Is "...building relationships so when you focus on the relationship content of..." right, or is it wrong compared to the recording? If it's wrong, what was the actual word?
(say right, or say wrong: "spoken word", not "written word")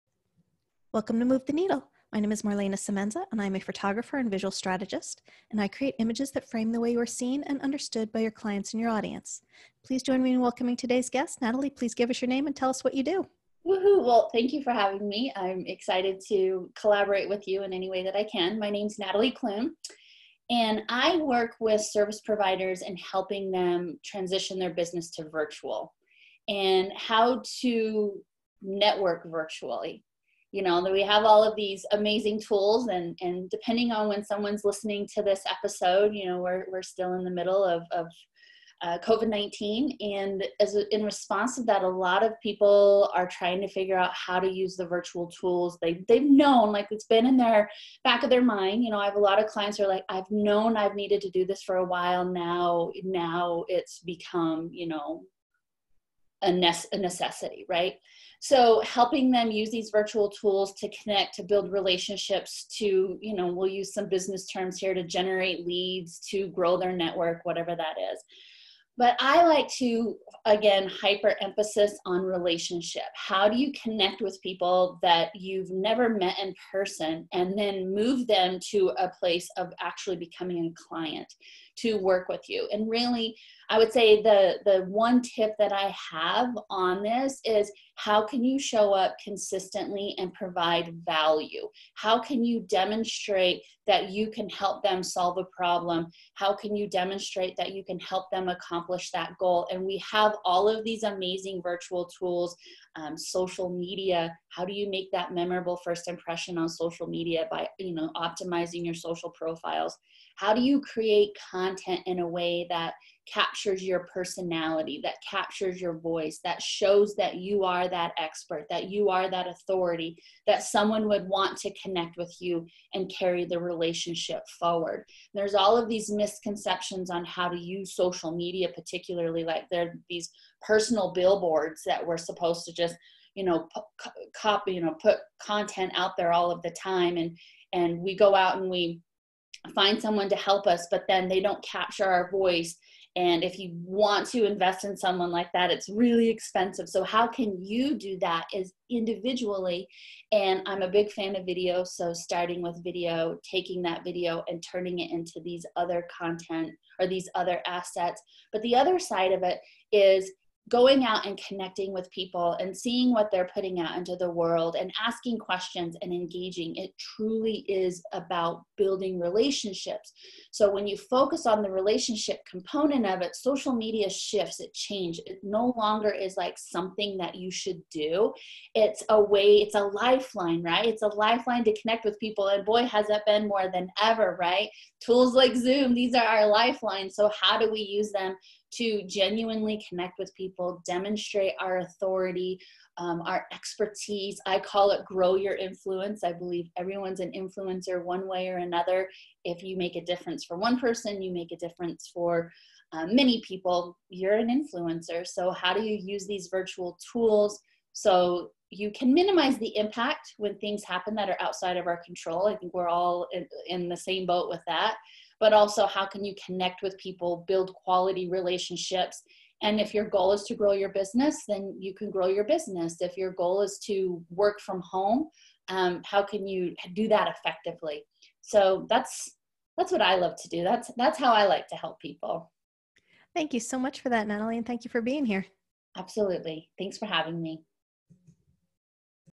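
wrong: "component", not "content".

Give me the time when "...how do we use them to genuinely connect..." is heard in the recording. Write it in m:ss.
3:07.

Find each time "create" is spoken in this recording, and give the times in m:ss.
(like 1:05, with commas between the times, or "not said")
0:05, 1:50.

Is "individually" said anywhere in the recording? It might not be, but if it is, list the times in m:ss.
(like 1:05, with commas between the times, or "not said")
2:28.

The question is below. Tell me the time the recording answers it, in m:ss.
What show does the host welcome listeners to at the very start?
0:01.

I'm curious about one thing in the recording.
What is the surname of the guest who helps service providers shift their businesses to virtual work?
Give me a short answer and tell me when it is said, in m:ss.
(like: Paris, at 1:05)
Klun, at 0:19.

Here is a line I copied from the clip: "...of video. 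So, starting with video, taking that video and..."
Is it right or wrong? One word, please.
right.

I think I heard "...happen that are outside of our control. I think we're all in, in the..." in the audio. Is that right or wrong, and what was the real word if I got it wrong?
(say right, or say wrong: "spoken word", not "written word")
right.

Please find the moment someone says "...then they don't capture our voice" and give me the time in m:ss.
2:21.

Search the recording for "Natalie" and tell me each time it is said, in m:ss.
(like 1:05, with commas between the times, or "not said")
0:11, 0:18, 3:54.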